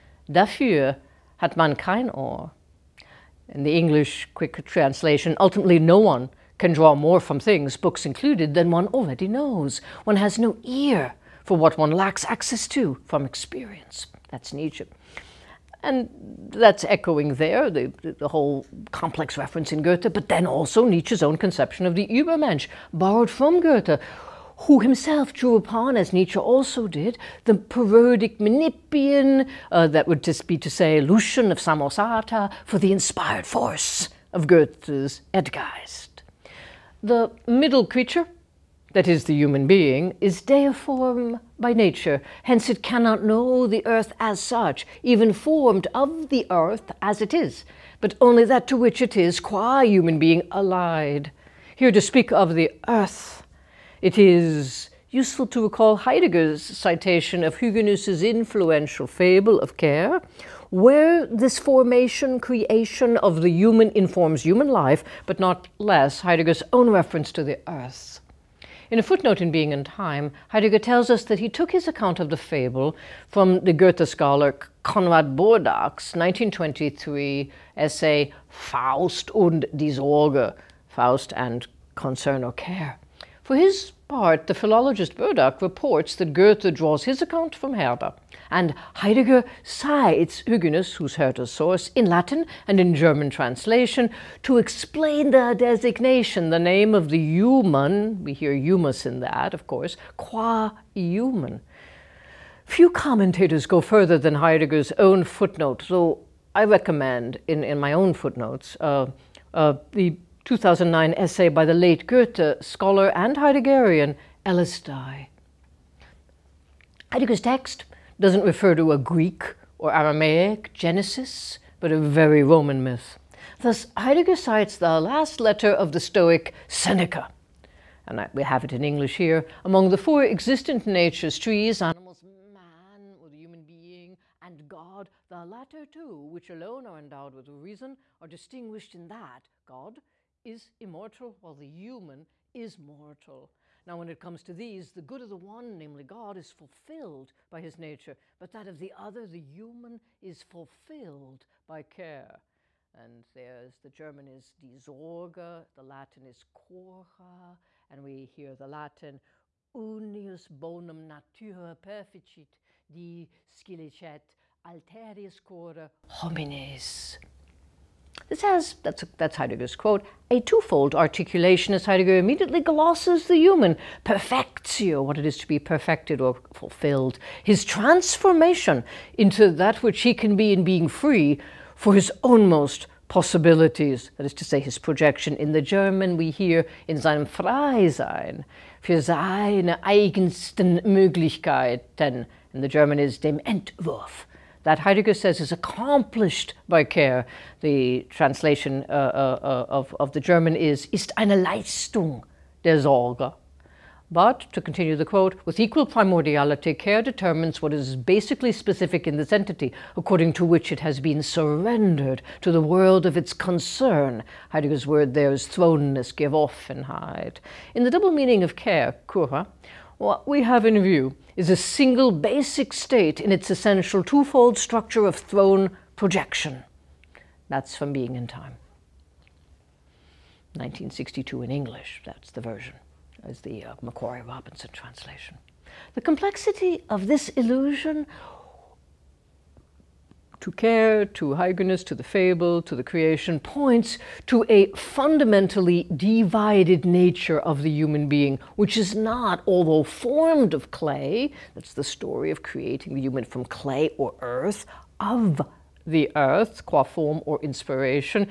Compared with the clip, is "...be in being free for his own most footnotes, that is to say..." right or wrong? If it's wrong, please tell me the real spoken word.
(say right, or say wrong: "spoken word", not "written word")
wrong: "possibilities", not "footnotes".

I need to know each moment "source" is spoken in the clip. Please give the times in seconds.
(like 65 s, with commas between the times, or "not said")
91 s.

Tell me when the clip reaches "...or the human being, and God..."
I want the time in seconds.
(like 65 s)
133 s.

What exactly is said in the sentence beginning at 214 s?
Heidegger's word there is thrownness, give off, and hide.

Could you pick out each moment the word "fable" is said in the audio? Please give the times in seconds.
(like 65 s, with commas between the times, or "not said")
59 s, 72 s, 242 s.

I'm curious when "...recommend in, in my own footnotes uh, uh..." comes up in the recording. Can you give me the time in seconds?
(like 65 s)
106 s.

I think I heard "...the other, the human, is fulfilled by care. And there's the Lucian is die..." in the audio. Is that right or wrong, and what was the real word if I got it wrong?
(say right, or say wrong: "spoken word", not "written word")
wrong: "German", not "Lucian".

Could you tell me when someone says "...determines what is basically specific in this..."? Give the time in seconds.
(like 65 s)
207 s.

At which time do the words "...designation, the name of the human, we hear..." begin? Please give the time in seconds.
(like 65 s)
95 s.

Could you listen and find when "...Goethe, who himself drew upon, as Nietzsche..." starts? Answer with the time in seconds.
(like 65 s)
23 s.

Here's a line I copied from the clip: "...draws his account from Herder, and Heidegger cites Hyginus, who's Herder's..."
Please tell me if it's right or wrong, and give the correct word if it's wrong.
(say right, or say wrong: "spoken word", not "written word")
right.